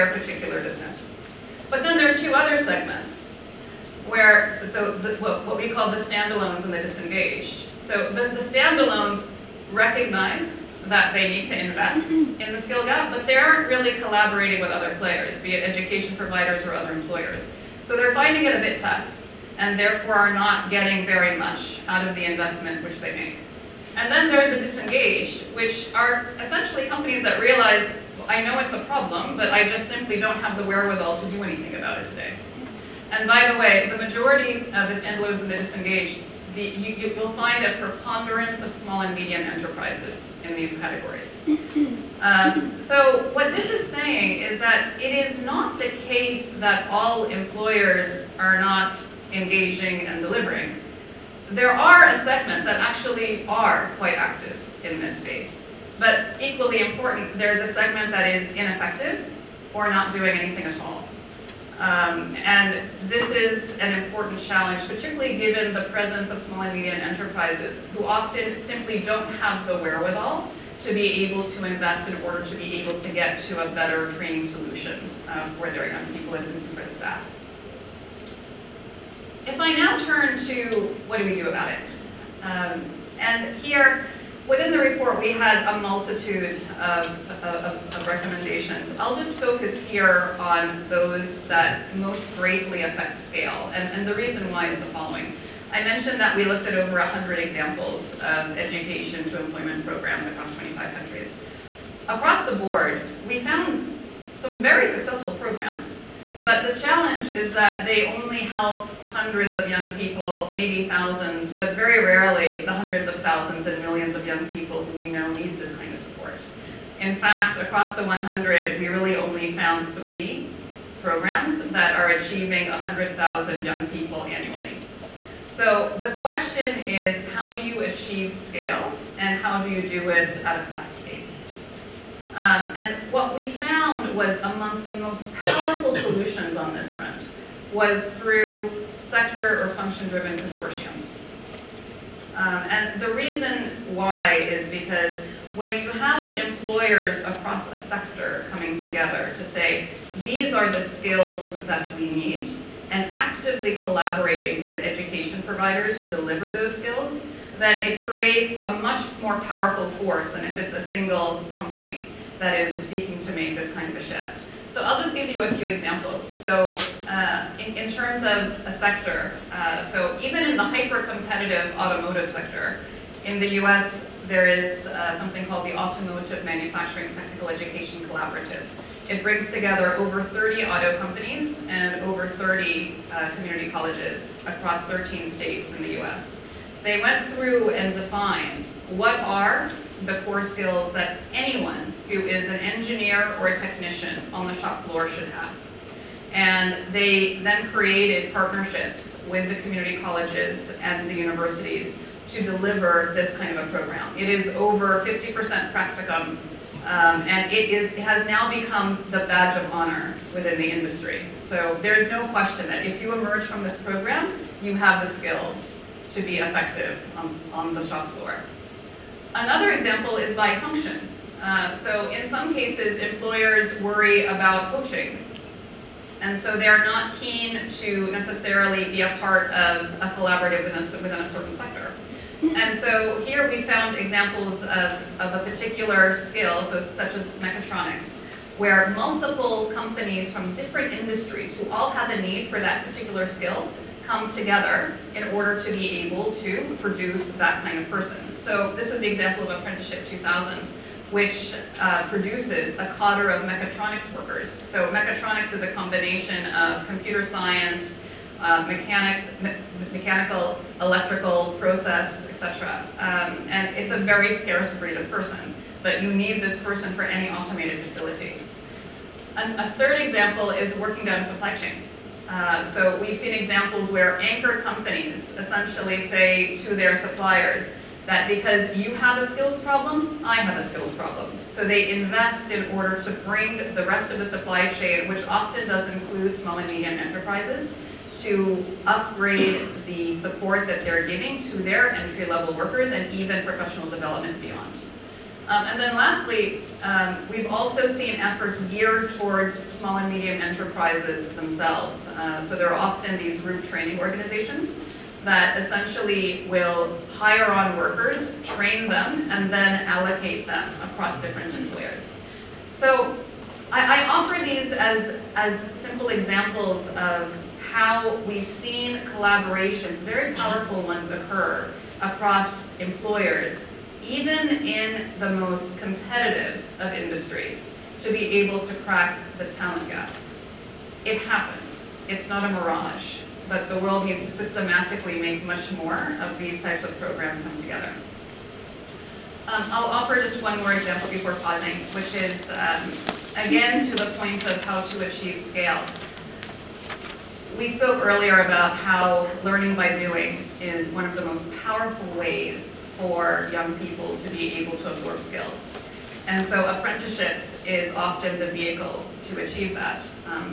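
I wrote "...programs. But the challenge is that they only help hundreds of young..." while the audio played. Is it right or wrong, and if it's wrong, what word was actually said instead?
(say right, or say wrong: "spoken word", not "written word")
right.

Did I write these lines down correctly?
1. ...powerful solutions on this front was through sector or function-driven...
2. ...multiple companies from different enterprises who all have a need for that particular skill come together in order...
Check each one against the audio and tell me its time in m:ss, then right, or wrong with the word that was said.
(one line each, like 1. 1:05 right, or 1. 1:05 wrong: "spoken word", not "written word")
1. 2:15 right
2. 3:58 wrong: "industries", not "enterprises".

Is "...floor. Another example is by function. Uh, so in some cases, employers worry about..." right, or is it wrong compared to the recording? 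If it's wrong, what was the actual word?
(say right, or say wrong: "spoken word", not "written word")
right.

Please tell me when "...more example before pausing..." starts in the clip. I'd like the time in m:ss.
5:40.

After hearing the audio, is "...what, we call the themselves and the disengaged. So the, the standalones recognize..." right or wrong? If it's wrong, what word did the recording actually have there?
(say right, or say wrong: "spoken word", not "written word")
wrong: "standalones", not "themselves".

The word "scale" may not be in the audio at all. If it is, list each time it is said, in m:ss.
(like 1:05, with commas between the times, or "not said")
1:33, 2:08, 5:45.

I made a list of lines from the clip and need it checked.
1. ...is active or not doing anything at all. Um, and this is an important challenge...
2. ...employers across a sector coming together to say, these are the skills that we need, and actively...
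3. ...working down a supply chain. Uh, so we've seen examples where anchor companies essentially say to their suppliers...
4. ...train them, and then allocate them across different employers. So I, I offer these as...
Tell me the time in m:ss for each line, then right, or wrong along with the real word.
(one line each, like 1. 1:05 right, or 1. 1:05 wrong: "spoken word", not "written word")
1. 0:58 wrong: "ineffective", not "active"
2. 2:26 right
3. 4:30 right
4. 5:08 right.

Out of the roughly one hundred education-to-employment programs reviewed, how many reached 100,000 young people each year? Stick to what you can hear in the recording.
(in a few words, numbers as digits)
3.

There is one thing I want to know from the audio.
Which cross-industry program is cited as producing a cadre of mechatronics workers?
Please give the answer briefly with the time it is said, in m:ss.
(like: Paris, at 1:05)
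Apprenticeship 2000, at 4:09.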